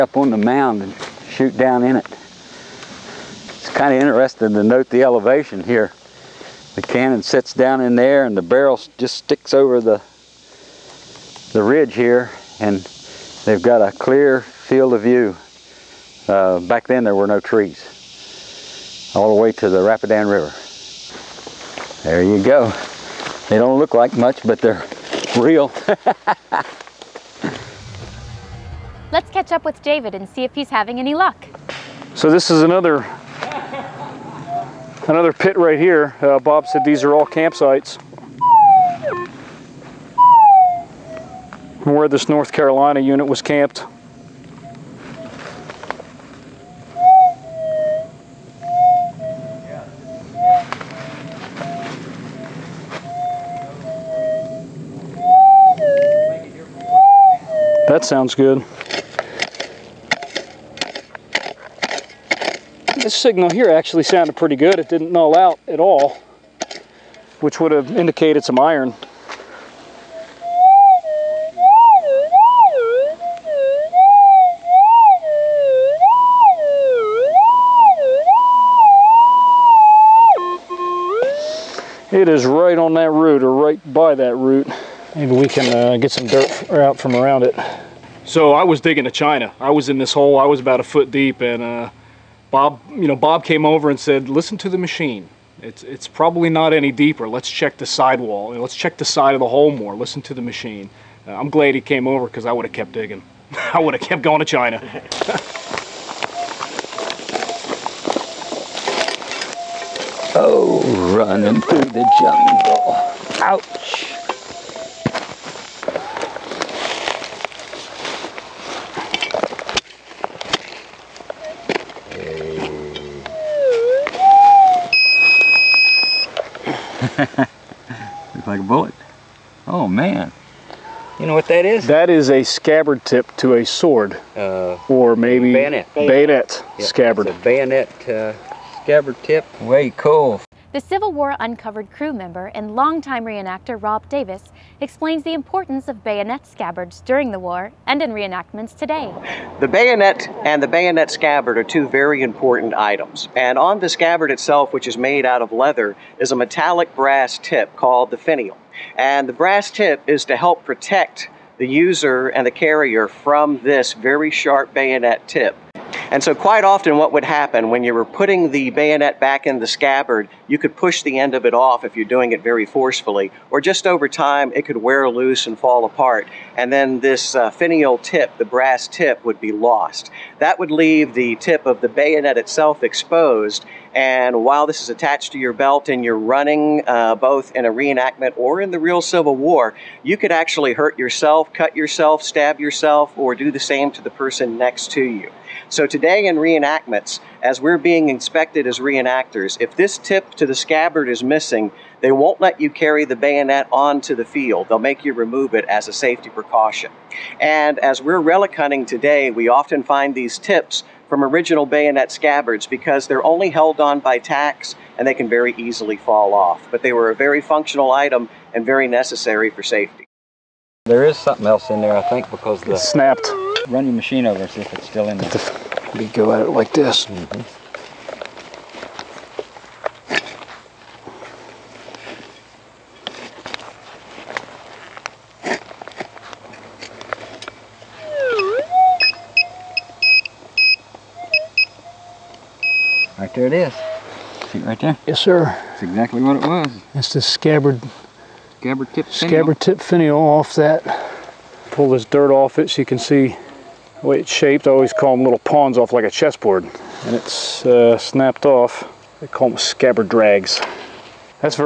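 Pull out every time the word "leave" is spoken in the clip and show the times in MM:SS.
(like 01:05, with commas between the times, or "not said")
03:00.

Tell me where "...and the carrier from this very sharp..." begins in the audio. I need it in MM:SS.
02:42.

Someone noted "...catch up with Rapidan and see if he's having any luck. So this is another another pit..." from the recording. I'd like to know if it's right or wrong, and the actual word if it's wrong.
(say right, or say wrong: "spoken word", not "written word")
wrong: "David", not "Rapidan".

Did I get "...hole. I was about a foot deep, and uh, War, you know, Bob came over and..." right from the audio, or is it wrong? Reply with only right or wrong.
wrong.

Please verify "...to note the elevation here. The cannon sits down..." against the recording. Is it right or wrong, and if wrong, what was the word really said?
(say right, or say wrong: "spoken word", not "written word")
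right.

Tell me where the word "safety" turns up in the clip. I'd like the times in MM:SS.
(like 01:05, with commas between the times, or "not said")
03:25, 03:39.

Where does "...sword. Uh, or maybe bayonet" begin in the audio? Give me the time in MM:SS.
02:13.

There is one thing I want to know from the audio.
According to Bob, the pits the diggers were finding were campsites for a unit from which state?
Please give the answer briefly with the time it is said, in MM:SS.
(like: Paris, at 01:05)
North Carolina, at 00:42.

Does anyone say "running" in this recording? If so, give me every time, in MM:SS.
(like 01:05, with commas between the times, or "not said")
01:51, 03:06.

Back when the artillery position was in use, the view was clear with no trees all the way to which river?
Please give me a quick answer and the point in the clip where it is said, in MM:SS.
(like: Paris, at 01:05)
Rapidan River, at 00:19.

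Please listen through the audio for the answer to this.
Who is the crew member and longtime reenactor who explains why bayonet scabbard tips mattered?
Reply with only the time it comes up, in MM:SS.
02:23.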